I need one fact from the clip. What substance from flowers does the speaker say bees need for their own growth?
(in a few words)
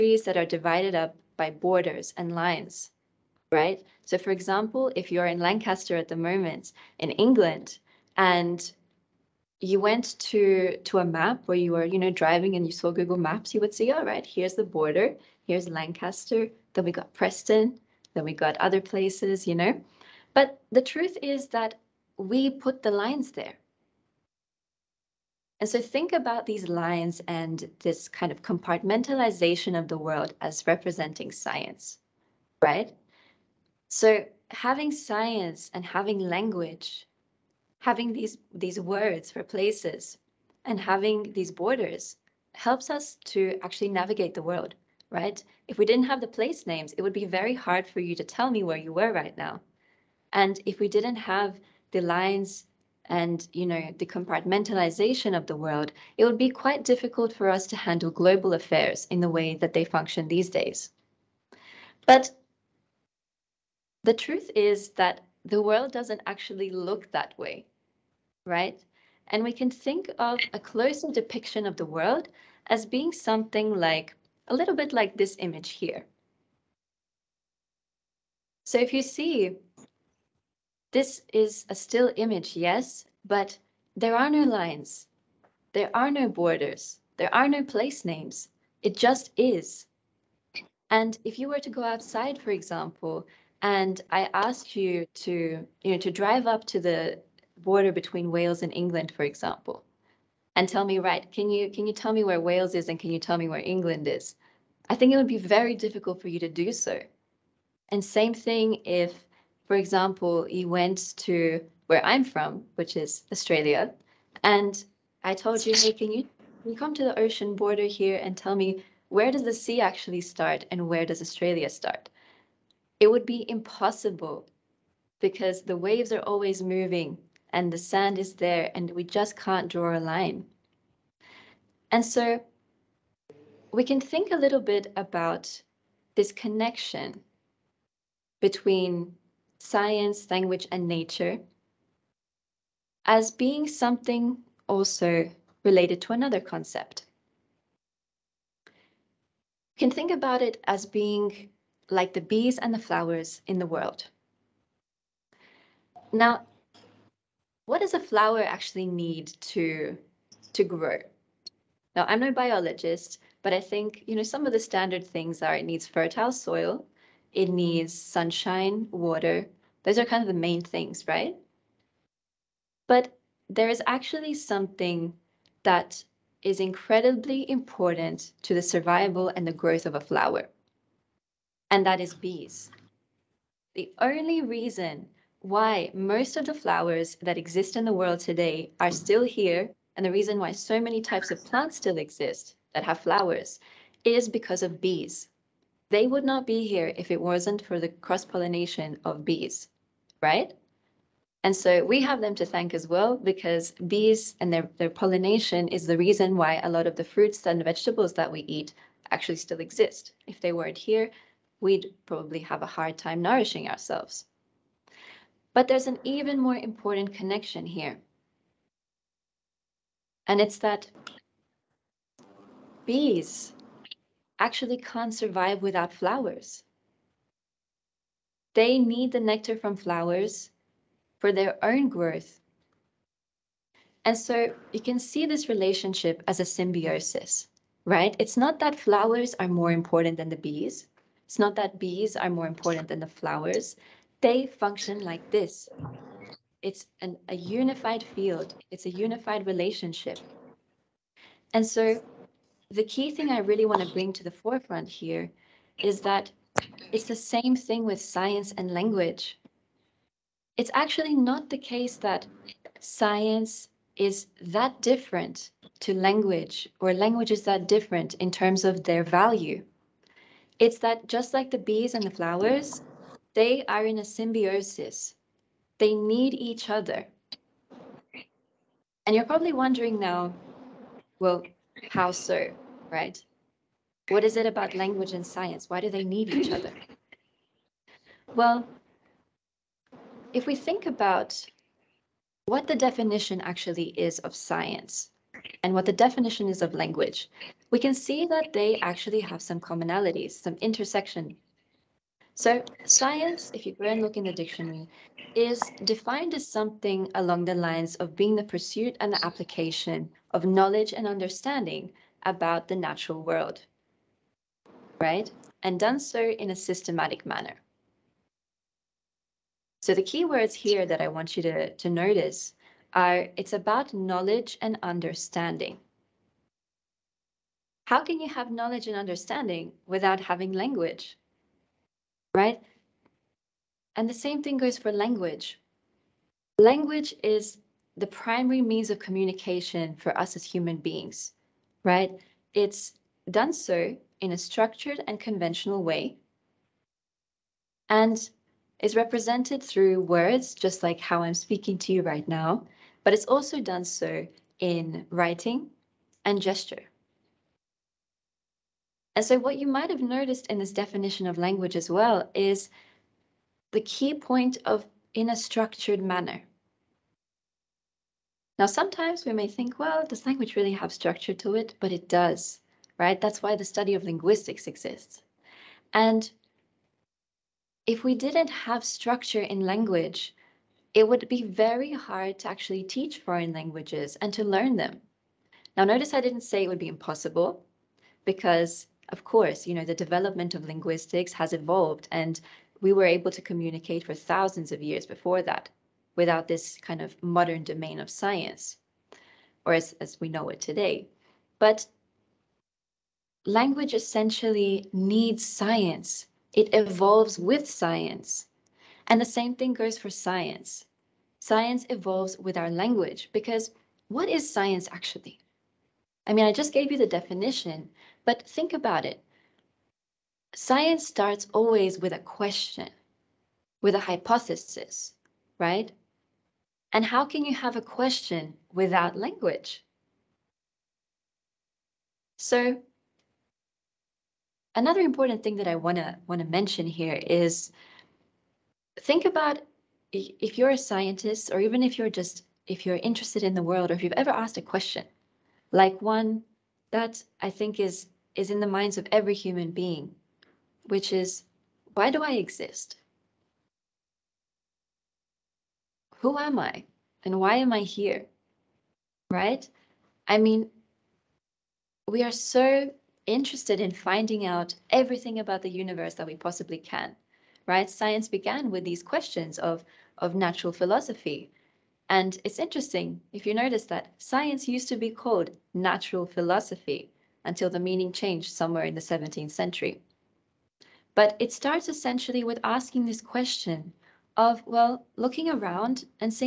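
Nectar.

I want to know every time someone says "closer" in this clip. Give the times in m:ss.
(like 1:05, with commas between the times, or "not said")
1:10.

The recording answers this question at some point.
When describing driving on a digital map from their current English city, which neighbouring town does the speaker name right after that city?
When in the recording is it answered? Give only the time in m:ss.
0:17.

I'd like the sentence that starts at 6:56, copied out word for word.
I mean, I just gave you the definition, but think about it.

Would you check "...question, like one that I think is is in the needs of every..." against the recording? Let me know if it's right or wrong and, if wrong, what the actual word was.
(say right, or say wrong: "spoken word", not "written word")
wrong: "minds", not "needs".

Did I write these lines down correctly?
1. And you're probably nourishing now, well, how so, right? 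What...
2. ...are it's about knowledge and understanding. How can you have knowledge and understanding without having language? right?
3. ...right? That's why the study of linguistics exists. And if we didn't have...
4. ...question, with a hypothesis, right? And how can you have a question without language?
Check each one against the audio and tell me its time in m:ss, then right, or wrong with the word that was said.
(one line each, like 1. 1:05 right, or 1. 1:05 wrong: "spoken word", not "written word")
1. 4:39 wrong: "wondering", not "nourishing"
2. 5:22 right
3. 6:12 right
4. 7:02 right.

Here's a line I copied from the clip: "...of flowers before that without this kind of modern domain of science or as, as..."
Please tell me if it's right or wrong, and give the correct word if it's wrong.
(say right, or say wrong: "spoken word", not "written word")
wrong: "years", not "flowers".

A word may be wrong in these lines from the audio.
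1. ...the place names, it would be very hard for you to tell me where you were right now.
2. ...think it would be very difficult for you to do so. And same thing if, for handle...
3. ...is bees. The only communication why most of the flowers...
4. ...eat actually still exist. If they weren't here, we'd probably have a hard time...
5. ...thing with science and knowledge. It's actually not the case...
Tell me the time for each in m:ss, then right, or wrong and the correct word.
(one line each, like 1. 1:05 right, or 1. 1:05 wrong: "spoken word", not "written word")
1. 0:46 right
2. 1:44 wrong: "example", not "handle"
3. 3:02 wrong: "reason", not "communication"
4. 3:28 right
5. 4:17 wrong: "language", not "knowledge".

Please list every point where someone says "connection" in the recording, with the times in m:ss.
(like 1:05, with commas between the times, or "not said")
2:16, 3:37.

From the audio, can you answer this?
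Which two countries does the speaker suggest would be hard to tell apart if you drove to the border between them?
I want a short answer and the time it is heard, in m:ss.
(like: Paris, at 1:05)
Wales and England, at 1:38.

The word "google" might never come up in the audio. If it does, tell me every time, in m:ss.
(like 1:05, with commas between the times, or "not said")
0:12.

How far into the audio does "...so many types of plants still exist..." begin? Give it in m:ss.
3:10.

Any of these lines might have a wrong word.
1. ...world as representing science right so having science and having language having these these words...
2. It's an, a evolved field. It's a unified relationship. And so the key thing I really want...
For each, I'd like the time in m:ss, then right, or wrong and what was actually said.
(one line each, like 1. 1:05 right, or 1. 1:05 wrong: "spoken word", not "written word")
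1. 0:29 right
2. 4:06 wrong: "unified", not "evolved".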